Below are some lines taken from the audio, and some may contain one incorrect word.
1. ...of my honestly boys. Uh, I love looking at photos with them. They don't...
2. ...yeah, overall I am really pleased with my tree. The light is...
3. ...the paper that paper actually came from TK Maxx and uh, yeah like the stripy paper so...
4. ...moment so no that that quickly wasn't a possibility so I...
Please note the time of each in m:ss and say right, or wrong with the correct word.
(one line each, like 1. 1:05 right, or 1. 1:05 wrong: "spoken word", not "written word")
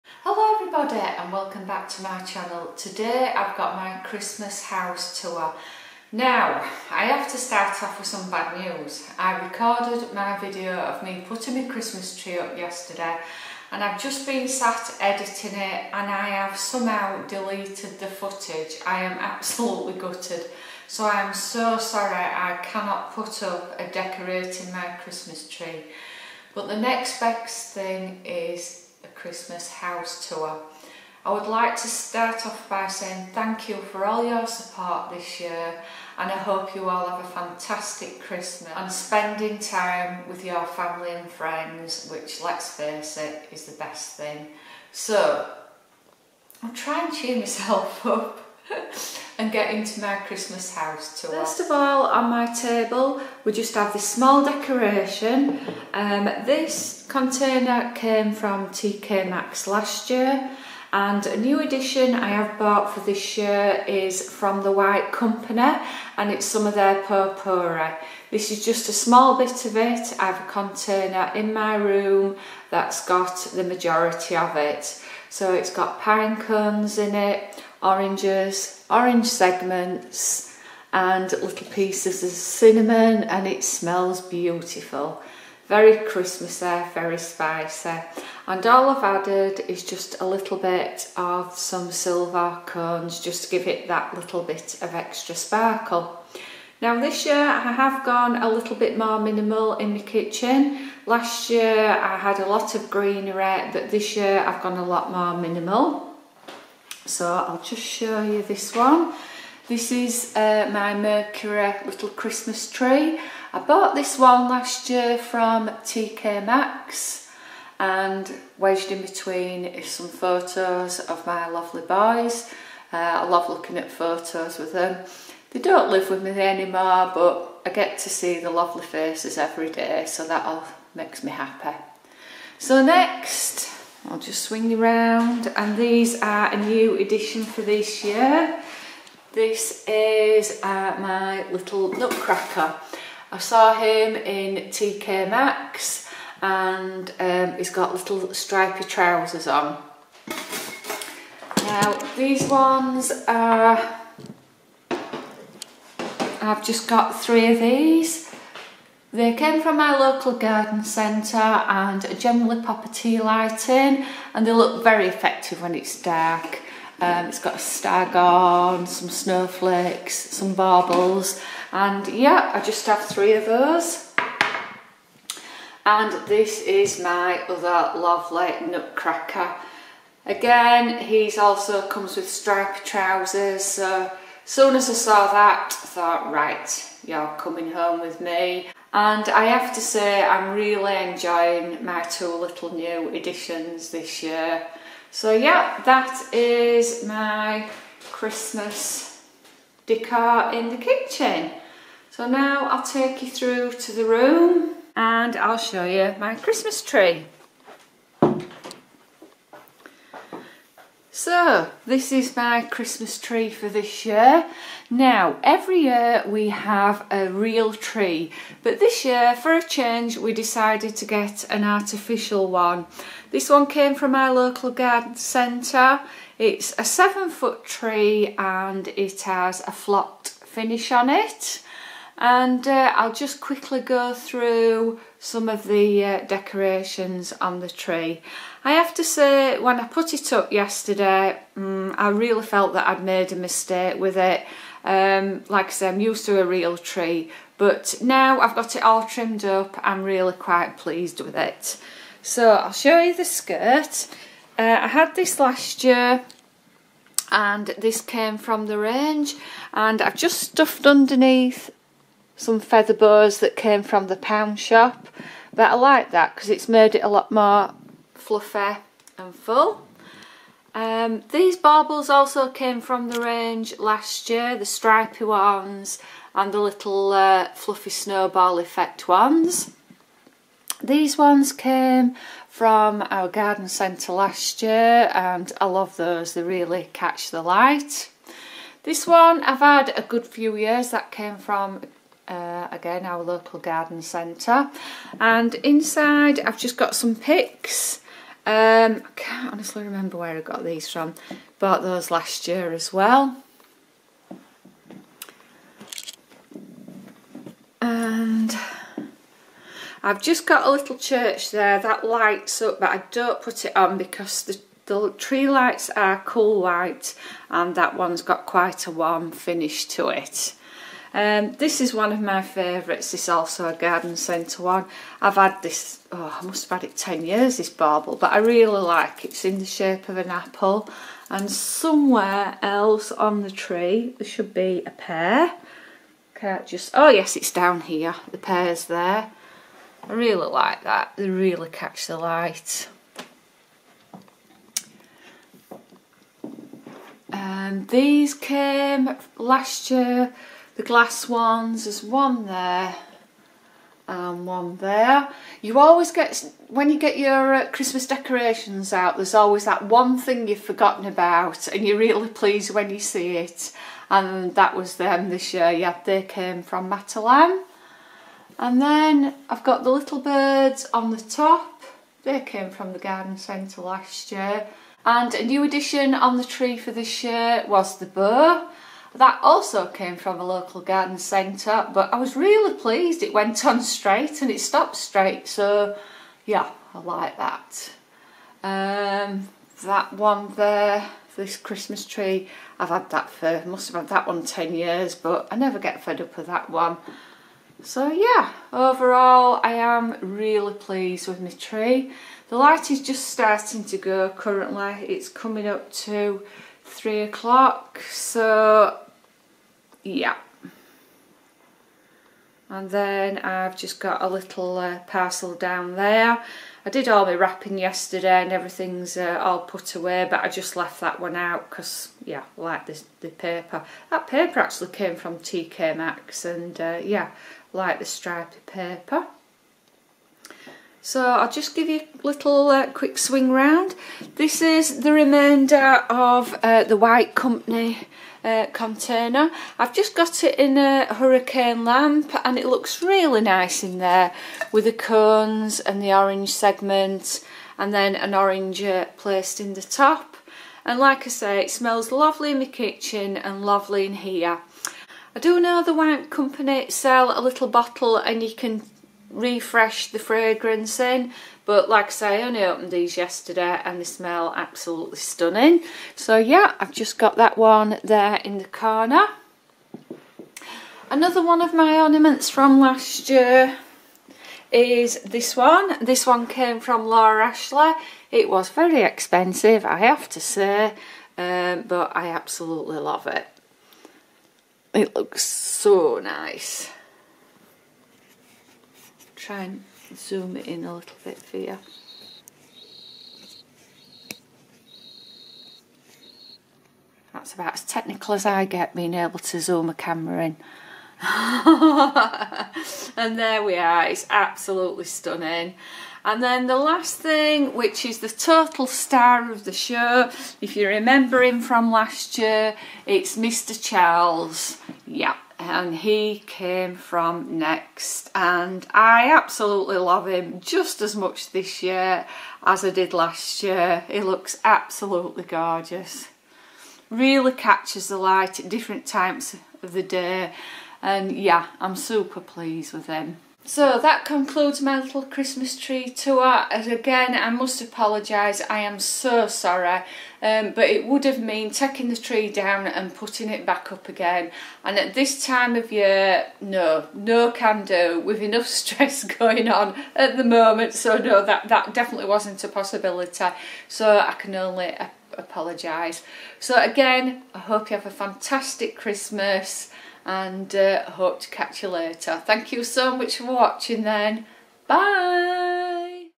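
1. 2:00 wrong: "lovely", not "honestly"
2. 6:38 right
3. 7:03 right
4. 9:10 wrong: "definitely", not "quickly".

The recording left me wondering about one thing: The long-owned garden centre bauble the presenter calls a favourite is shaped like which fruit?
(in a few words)
An apple.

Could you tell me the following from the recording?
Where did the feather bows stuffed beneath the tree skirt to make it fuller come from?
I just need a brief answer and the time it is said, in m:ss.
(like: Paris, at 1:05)
The pound shop, at 4:24.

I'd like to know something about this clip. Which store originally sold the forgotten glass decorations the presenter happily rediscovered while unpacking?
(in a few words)
Matalan.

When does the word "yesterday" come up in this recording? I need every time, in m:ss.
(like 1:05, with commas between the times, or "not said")
0:12, 4:00, 6:57, 7:43.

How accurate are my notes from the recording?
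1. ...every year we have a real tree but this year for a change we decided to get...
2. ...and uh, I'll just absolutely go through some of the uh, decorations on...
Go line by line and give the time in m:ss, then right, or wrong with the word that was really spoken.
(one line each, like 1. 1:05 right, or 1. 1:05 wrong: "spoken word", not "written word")
1. 3:35 right
2. 3:52 wrong: "quickly", not "absolutely".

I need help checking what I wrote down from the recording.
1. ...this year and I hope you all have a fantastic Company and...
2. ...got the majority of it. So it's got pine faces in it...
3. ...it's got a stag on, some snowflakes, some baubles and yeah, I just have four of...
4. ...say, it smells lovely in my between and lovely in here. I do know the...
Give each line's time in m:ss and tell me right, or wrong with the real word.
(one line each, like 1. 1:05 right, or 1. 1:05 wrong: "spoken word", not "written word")
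1. 0:35 wrong: "Christmas", not "Company"
2. 1:13 wrong: "cones", not "faces"
3. 2:47 wrong: "three", not "four"
4. 7:31 wrong: "kitchen", not "between".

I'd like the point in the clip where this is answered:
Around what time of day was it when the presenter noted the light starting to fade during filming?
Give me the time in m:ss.
6:46.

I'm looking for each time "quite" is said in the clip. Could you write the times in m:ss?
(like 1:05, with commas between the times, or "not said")
4:10, 5:18.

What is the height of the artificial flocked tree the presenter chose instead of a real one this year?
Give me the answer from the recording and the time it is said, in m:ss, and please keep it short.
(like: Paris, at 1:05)
7 foot, at 3:46.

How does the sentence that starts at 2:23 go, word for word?
I saw him in TK Maxx and um, he's got little stripy trousers on.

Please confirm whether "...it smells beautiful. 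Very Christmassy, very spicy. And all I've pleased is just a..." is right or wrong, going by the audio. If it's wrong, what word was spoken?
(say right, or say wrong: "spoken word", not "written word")
wrong: "added", not "pleased".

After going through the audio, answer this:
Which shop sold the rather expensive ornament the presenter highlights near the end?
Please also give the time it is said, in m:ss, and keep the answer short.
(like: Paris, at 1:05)
Laura Ashley, at 7:57.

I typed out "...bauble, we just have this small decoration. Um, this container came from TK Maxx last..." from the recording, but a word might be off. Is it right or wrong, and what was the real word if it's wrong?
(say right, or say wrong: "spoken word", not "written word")
wrong: "table", not "bauble".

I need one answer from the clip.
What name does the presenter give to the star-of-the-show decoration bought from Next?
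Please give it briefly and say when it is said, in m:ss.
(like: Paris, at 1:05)
Mr. Charles, at 8:33.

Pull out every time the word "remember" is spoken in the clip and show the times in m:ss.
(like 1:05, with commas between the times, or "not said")
4:59, 8:30.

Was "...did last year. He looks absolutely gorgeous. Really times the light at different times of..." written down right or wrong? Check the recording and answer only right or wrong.
wrong.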